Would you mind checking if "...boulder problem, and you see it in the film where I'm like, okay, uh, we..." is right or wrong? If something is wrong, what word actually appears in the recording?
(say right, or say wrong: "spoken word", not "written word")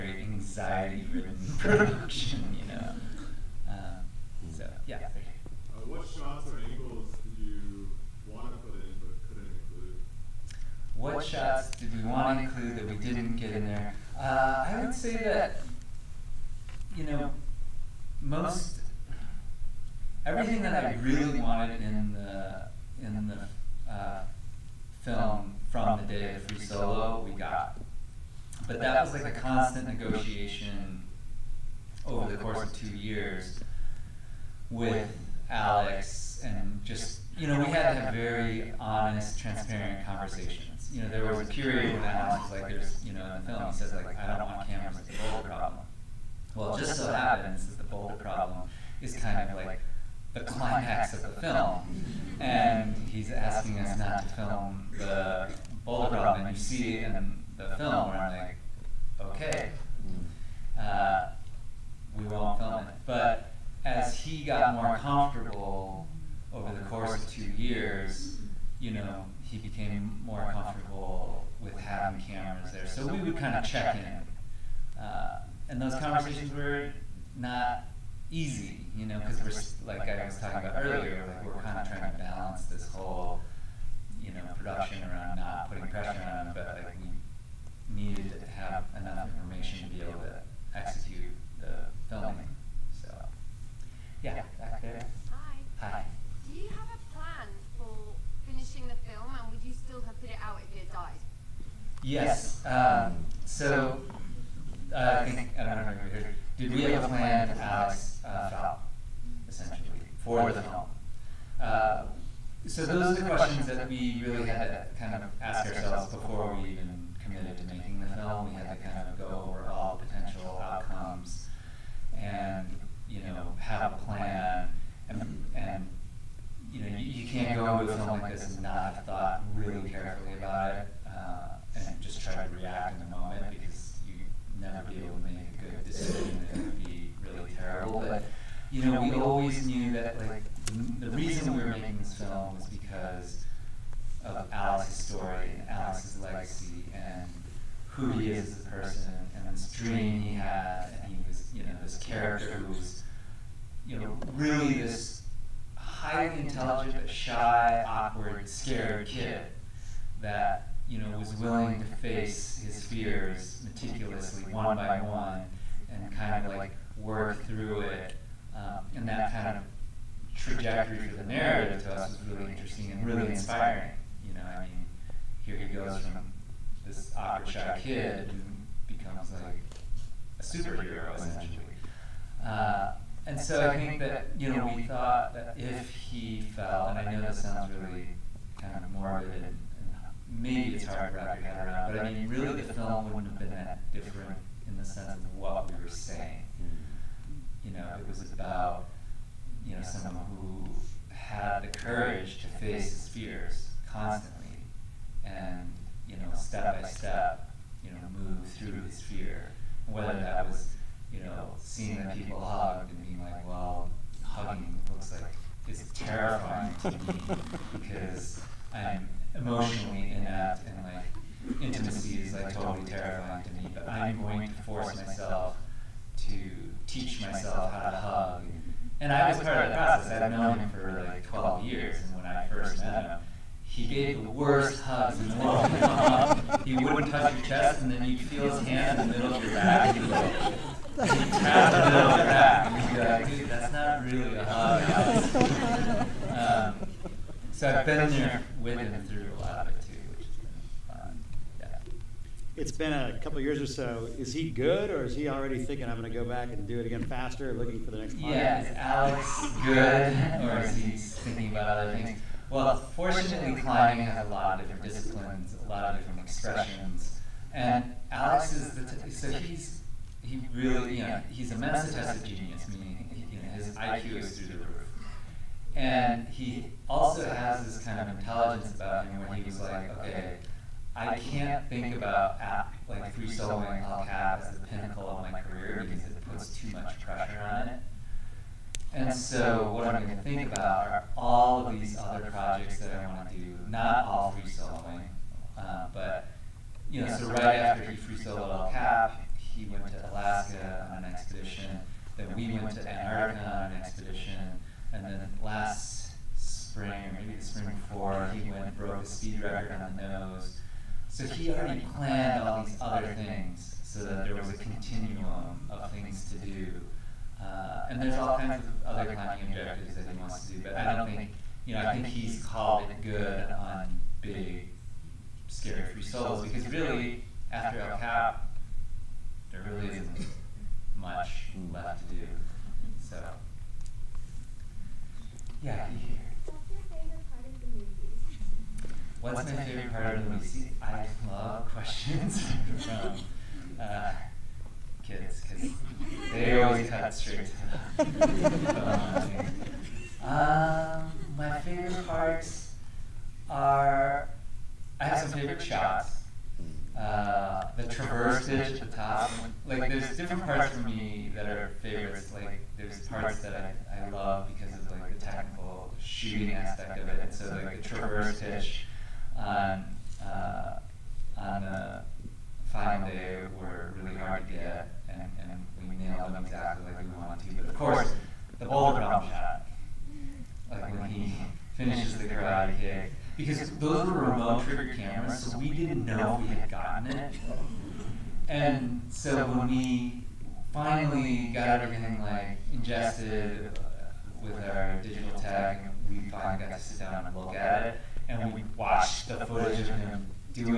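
right.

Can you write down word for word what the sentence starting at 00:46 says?
Well, just so happens that the boulder problem is kind of like the climax of the film.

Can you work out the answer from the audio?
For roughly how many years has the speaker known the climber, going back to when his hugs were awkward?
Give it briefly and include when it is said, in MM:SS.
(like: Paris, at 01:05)
12 years, at 03:51.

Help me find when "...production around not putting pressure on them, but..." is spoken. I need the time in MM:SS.
01:24.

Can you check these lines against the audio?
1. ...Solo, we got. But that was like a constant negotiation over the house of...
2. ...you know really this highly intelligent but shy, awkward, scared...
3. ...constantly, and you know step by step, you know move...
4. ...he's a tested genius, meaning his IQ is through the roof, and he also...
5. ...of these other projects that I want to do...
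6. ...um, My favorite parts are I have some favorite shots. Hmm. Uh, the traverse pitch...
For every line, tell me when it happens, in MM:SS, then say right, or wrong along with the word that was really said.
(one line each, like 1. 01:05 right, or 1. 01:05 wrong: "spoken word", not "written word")
1. 00:26 wrong: "course", not "house"
2. 02:33 right
3. 03:23 right
4. 04:31 right
5. 04:51 right
6. 05:50 right.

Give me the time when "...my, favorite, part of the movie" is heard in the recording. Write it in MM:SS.
05:39.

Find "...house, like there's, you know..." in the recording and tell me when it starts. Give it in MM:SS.
00:42.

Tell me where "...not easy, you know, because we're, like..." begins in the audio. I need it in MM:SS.
01:17.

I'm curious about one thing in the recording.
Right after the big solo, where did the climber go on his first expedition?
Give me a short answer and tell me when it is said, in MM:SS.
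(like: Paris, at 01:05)
Alaska, at 05:00.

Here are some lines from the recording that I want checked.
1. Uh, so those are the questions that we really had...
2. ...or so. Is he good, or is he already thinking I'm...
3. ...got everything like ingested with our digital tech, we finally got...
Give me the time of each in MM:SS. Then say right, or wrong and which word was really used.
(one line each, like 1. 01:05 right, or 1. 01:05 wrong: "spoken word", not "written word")
1. 01:51 right
2. 04:13 right
3. 06:31 right.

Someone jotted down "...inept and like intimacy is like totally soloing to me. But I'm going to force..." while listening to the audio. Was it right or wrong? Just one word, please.
wrong.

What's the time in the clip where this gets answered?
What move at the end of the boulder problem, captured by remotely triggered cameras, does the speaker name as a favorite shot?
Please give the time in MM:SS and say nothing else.
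06:22.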